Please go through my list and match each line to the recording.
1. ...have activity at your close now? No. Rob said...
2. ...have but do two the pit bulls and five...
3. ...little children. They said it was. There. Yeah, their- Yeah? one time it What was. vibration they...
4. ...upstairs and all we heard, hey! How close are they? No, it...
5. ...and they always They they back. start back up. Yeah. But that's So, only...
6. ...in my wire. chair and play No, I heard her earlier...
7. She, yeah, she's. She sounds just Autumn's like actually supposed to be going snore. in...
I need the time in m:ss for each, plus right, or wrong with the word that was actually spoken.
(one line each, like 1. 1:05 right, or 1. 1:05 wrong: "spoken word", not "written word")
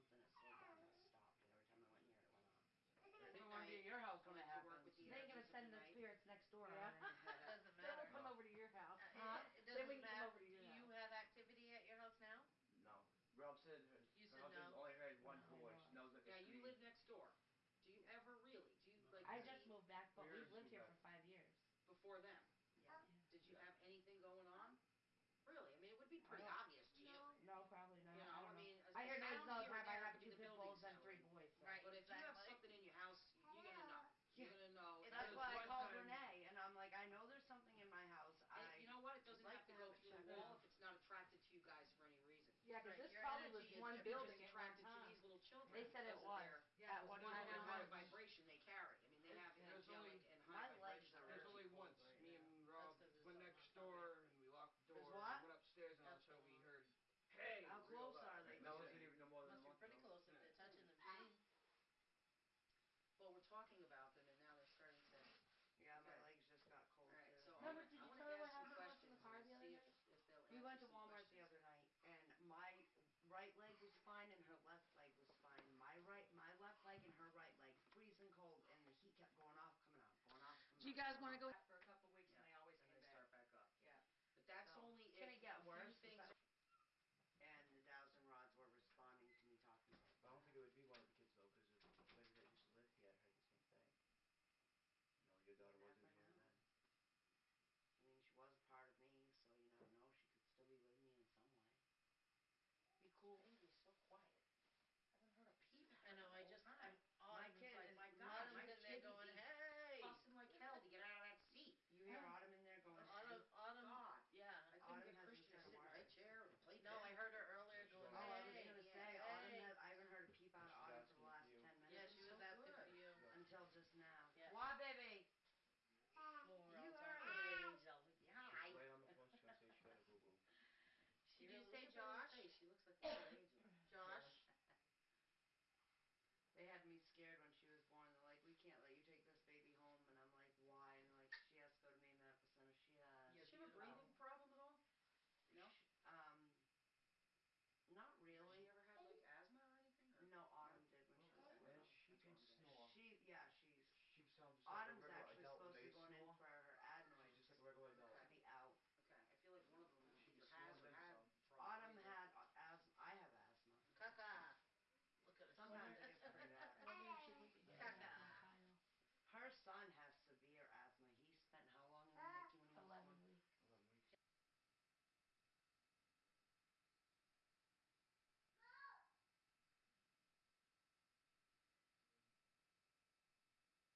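1. 0:10 wrong: "house", not "close"
2. 0:29 wrong: "three", not "five"
3. 0:45 wrong: "What", not "Yeah"
4. 0:55 right
5. 1:22 wrong: "And", not "They"
6. 1:55 right
7. 2:32 right.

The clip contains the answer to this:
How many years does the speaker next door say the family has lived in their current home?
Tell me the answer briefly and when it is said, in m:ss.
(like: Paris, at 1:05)
5 years, at 0:20.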